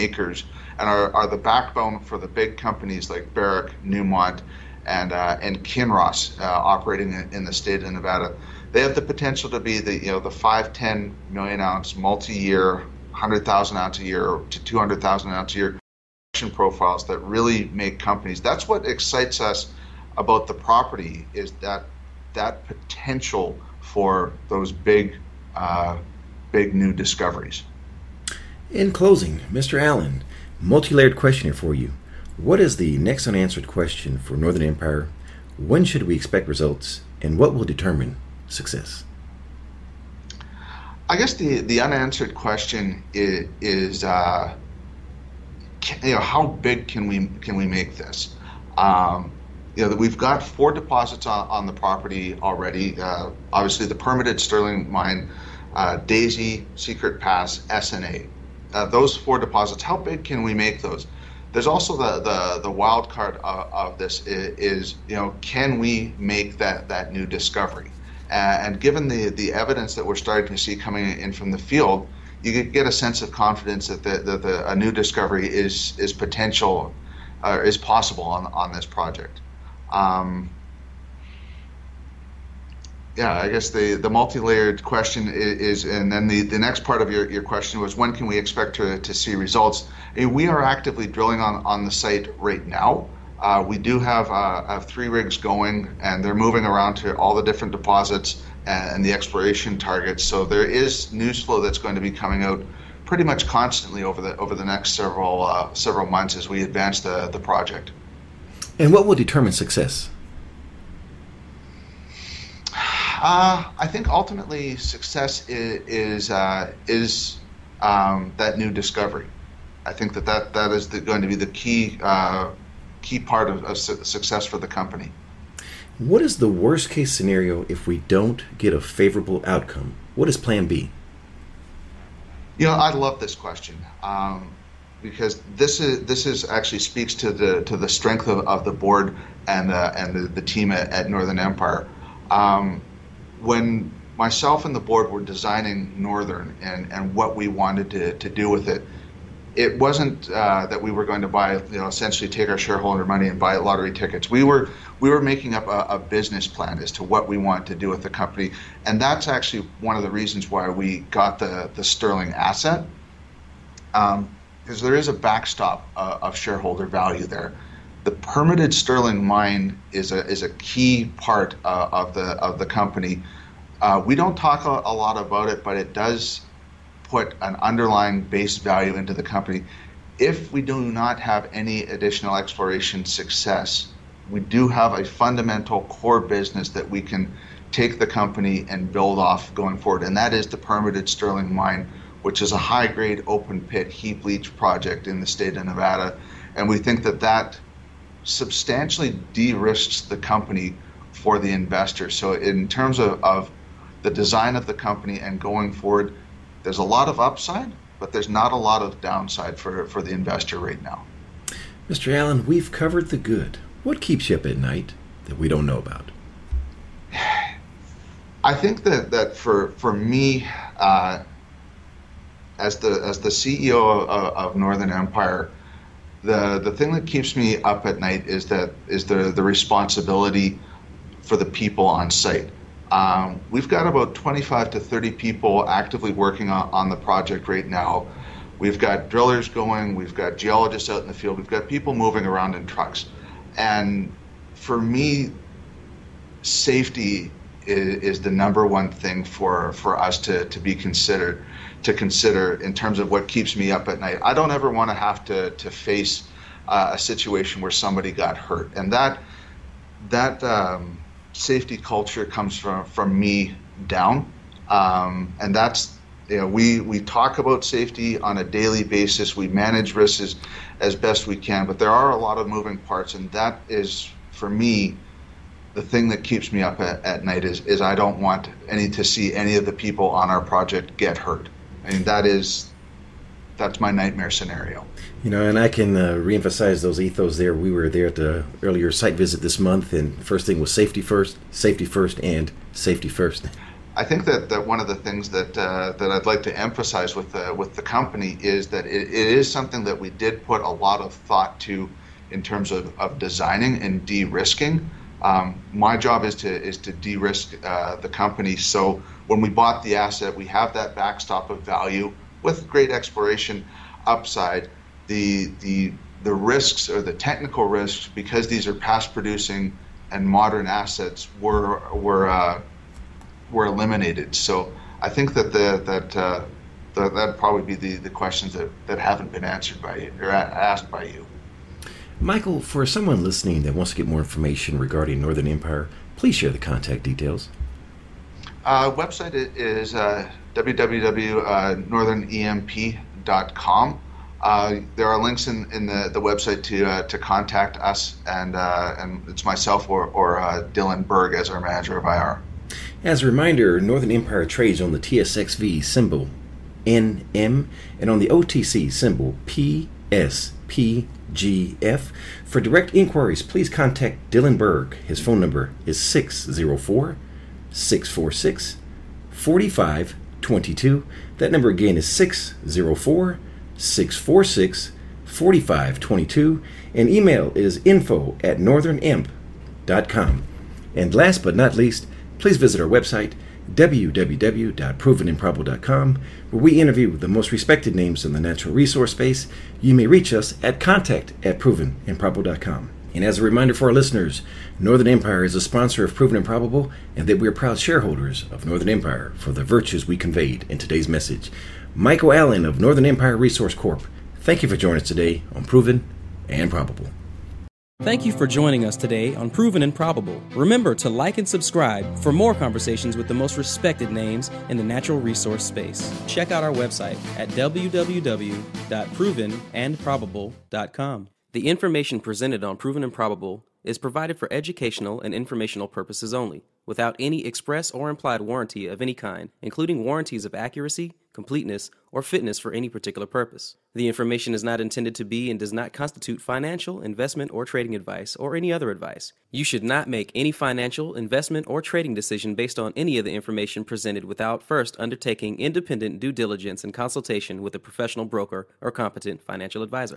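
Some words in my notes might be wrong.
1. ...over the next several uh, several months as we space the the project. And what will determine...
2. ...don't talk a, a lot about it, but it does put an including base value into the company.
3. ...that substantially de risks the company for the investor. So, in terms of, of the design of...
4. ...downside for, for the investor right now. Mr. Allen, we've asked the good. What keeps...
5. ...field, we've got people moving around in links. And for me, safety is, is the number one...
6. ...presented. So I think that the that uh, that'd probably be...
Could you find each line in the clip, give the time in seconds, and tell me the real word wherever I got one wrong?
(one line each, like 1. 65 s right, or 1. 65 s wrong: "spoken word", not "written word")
1. 104 s wrong: "advance", not "space"
2. 174 s wrong: "underlying", not "including"
3. 197 s right
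4. 209 s wrong: "covered", not "asked"
5. 241 s wrong: "trucks", not "links"
6. 323 s wrong: "eliminated", not "presented".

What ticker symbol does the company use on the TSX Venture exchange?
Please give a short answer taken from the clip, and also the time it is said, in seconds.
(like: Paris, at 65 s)
NM, at 356 s.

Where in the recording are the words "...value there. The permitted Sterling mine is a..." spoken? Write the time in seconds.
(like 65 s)
166 s.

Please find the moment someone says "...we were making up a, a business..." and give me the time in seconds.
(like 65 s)
155 s.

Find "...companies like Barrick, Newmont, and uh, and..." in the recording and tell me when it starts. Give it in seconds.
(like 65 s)
2 s.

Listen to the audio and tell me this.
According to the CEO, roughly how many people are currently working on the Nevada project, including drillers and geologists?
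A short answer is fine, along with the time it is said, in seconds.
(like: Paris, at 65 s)
25 to 30, at 234 s.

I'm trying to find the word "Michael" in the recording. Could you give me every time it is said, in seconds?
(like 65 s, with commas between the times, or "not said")
332 s, 401 s.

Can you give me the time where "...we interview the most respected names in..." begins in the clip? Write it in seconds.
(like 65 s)
386 s.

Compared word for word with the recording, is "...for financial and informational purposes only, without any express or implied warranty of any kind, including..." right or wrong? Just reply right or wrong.
wrong.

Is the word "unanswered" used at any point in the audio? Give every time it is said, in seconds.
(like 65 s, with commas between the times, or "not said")
33 s, 41 s.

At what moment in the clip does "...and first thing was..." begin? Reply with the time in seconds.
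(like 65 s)
289 s.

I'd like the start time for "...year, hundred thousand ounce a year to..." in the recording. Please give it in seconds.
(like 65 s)
12 s.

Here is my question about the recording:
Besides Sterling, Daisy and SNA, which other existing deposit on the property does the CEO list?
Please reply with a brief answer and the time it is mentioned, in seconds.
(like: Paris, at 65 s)
Secret Pass, at 56 s.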